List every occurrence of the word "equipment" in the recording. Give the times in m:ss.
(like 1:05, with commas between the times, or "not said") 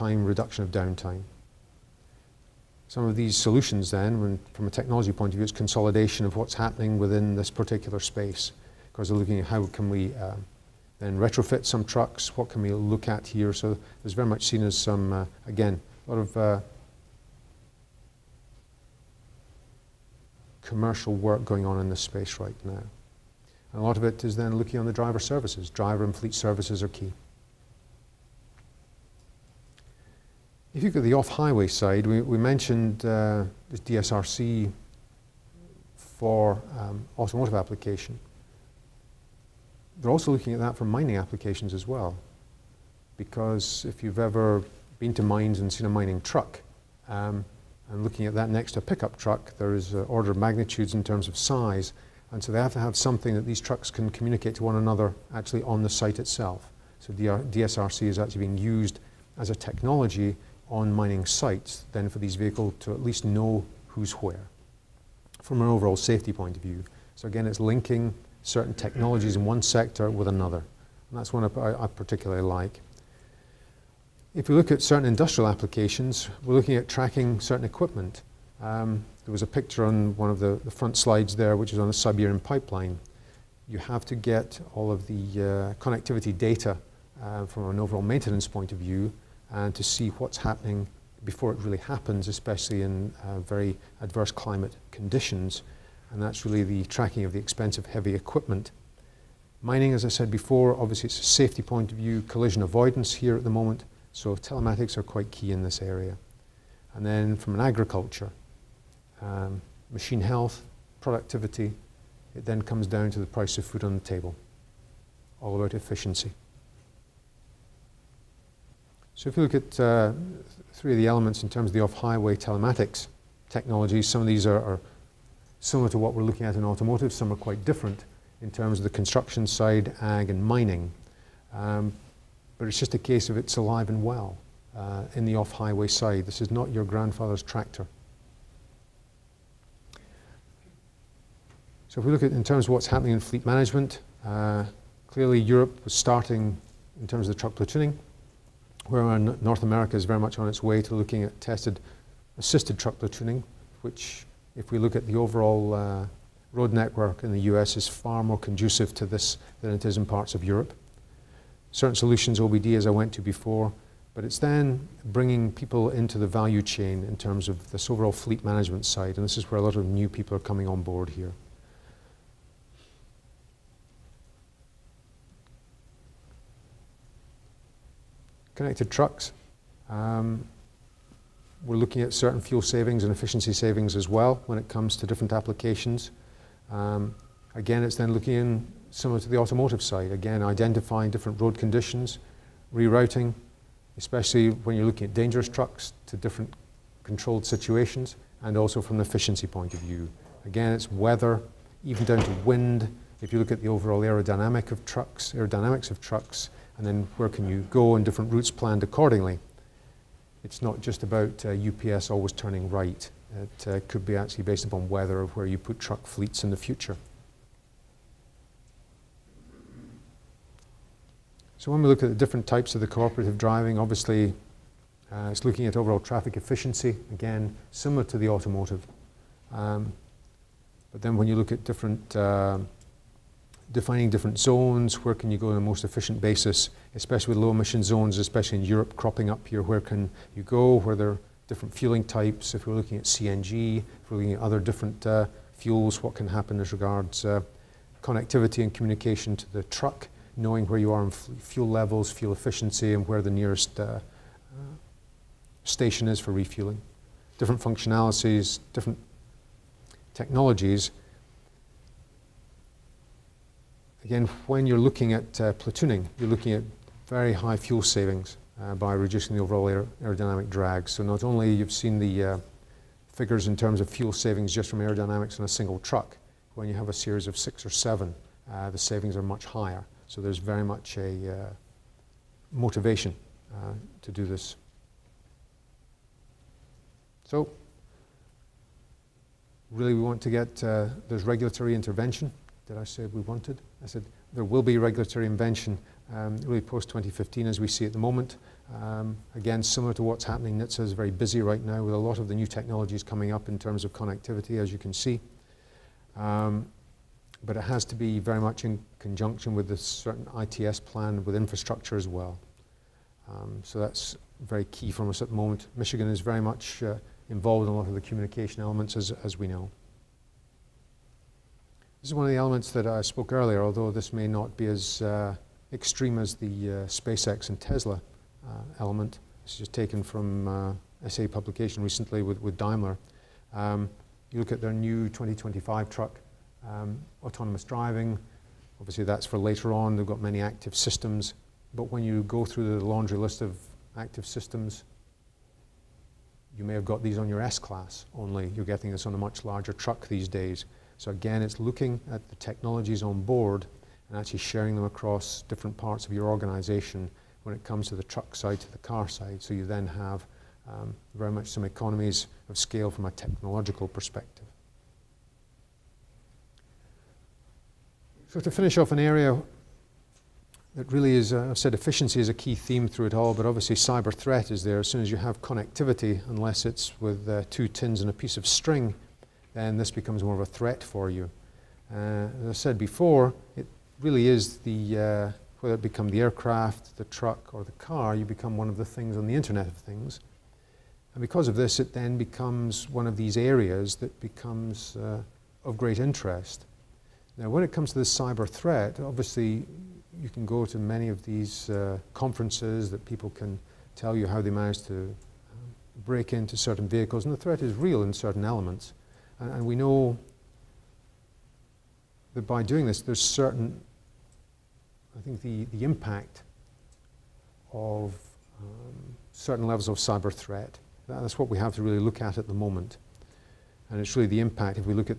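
1:17, 1:38.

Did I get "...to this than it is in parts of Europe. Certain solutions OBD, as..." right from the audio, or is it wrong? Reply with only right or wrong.
right.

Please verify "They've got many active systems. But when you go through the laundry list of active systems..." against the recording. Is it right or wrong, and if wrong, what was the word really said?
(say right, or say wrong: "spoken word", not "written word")
right.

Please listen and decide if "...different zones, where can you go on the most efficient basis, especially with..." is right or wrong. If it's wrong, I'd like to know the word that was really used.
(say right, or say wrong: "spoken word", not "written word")
right.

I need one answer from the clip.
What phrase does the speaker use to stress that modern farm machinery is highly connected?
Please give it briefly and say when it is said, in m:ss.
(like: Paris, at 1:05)
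not your grandfather's tractor, at 2:16.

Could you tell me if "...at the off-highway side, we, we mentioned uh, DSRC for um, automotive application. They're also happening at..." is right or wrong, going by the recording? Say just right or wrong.
wrong.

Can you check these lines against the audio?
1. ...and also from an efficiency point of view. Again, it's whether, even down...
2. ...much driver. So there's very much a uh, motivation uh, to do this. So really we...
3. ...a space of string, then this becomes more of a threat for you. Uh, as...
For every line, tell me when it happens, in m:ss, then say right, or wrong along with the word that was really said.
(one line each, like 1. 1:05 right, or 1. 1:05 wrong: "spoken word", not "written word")
1. 3:18 wrong: "weather", not "whether"
2. 4:39 wrong: "higher", not "driver"
3. 6:18 wrong: "piece", not "space".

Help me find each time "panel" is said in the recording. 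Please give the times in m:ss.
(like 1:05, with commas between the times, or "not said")
not said.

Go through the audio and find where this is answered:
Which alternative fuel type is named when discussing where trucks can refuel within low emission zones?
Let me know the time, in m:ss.
4:03.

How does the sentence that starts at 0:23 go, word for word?
And a lot of it is then looking on the driver services.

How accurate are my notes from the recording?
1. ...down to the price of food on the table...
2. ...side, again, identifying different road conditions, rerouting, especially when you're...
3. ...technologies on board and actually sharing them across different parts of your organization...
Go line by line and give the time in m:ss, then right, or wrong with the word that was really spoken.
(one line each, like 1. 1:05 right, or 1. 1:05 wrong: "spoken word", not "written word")
1. 1:52 right
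2. 3:09 right
3. 5:52 right.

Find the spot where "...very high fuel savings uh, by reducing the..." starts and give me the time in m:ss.
4:27.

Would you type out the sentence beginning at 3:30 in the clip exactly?
It's not just about uh, UPS always turning right.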